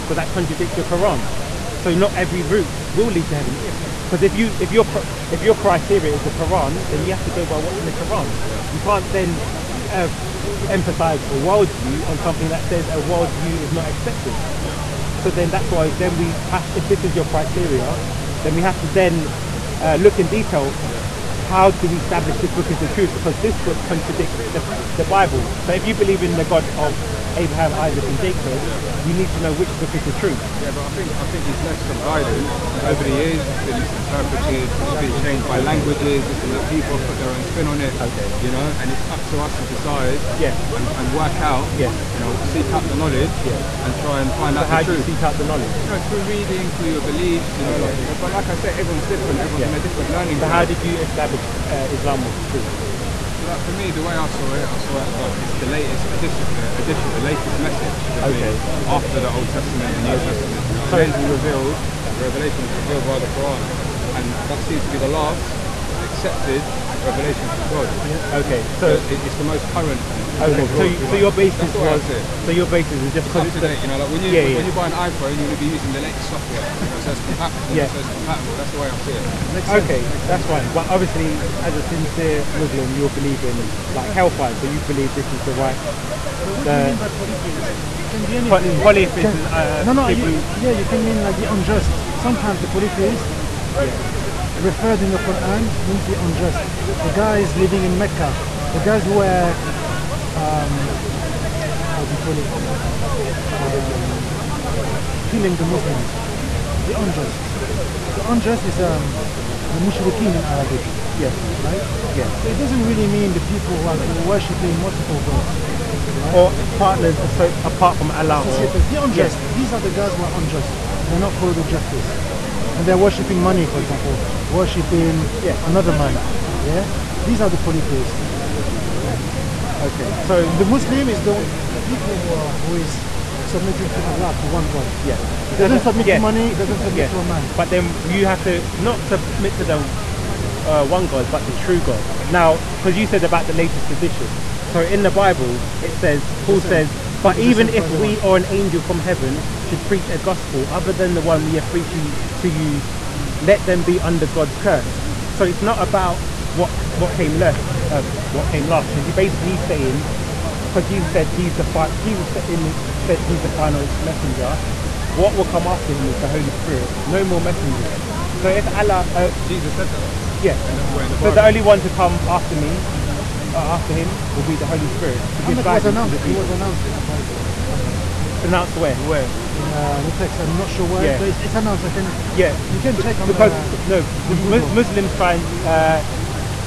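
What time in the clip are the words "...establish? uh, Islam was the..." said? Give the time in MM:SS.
00:50.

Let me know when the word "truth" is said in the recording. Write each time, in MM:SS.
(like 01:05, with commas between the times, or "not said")
00:22, 00:30, 00:44, 00:52.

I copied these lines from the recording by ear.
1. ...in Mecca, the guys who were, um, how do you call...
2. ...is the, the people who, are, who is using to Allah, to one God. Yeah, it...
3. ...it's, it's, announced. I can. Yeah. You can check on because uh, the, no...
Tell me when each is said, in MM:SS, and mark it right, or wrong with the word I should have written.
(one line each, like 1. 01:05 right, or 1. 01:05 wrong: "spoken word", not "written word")
1. 01:37 right
2. 02:11 wrong: "submitting", not "using"
3. 03:01 right.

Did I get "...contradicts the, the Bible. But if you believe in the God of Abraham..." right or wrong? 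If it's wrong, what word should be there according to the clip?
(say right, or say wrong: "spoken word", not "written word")
right.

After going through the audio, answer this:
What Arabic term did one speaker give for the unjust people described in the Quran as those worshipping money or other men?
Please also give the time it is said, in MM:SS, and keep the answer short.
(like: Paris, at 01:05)
mushrikeen, at 01:49.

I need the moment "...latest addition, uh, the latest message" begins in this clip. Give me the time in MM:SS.
00:55.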